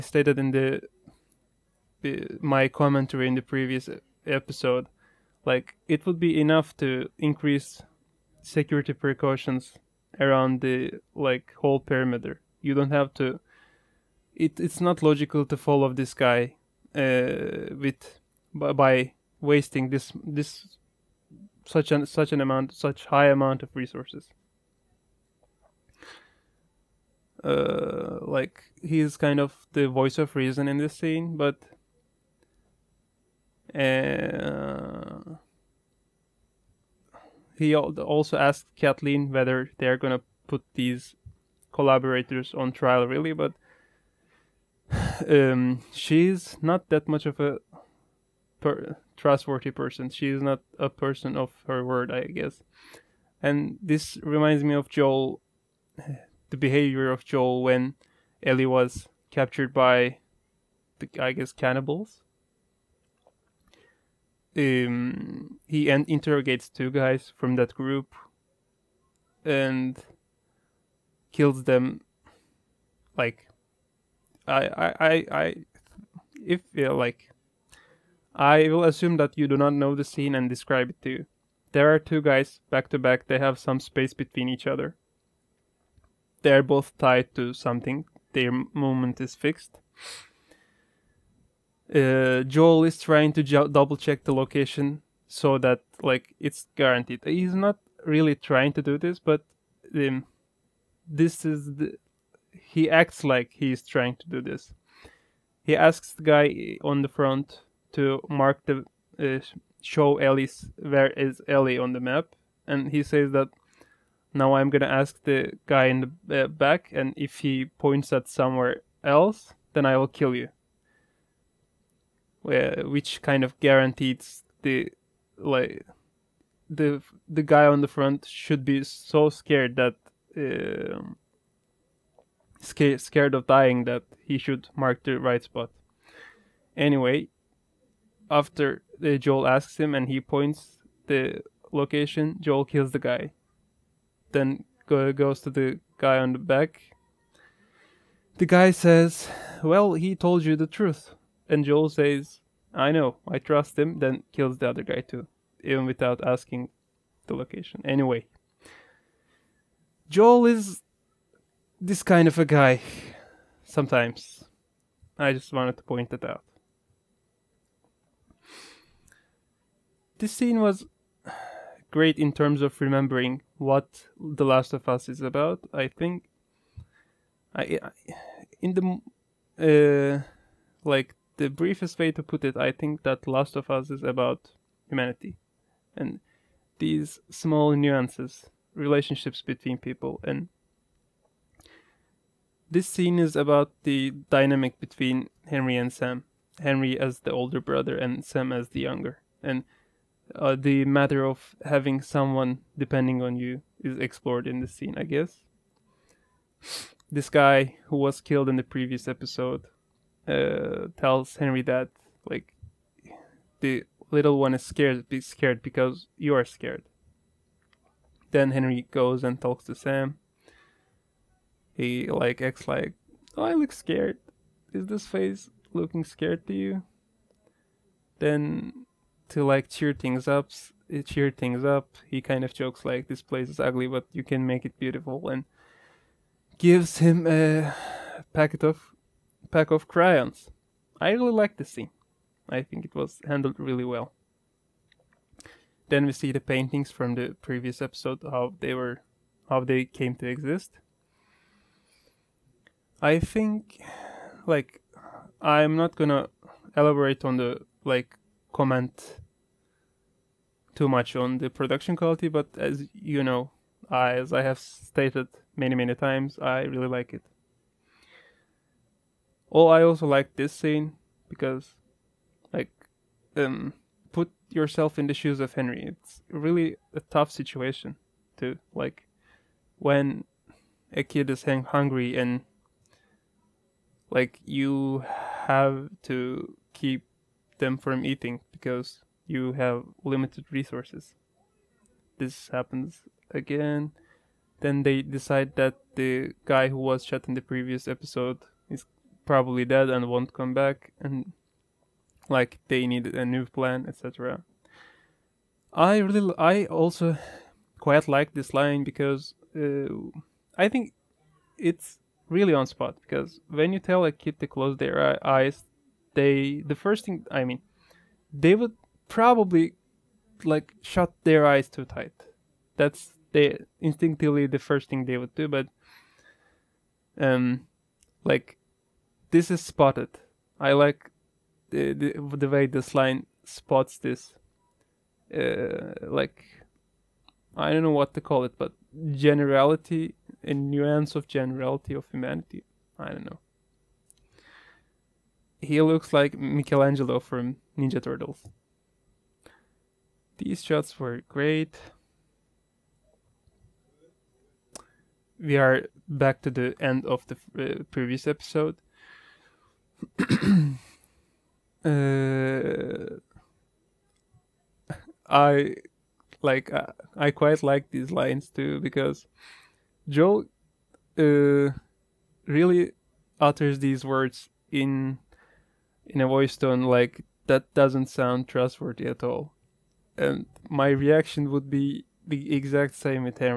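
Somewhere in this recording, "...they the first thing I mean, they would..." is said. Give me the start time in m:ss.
5:16.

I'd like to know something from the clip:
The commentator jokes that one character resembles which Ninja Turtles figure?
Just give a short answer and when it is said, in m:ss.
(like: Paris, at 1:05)
Michelangelo, at 5:46.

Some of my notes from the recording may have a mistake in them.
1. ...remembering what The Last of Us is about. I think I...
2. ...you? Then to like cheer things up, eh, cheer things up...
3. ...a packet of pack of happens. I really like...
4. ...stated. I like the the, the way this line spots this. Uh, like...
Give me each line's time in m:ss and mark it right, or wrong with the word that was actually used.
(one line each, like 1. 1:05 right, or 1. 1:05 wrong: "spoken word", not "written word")
1. 2:52 right
2. 3:46 right
3. 3:57 wrong: "crayons", not "happens"
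4. 5:29 wrong: "spotted", not "stated".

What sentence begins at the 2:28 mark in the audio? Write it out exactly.
The guy says, Well, he told you the truth.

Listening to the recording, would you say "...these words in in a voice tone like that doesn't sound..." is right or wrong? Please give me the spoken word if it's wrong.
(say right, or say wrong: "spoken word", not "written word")
right.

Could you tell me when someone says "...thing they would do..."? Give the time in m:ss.
5:24.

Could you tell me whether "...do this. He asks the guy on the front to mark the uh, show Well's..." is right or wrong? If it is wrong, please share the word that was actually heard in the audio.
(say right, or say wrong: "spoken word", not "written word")
wrong: "Ellie", not "Well".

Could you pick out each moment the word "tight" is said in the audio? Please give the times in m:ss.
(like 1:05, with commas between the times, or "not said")
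5:21.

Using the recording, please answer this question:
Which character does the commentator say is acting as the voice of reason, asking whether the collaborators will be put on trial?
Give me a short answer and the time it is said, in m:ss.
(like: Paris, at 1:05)
Kathleen, at 0:38.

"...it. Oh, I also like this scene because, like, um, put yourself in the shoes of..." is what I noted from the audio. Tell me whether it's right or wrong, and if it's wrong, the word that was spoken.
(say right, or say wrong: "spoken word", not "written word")
right.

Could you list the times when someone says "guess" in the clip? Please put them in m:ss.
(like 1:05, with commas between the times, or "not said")
0:52, 1:01, 3:25.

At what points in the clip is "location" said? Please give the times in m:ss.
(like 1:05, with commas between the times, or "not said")
1:34, 2:21, 2:37.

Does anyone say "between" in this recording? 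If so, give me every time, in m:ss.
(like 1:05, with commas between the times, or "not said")
1:24, 3:09, 3:14.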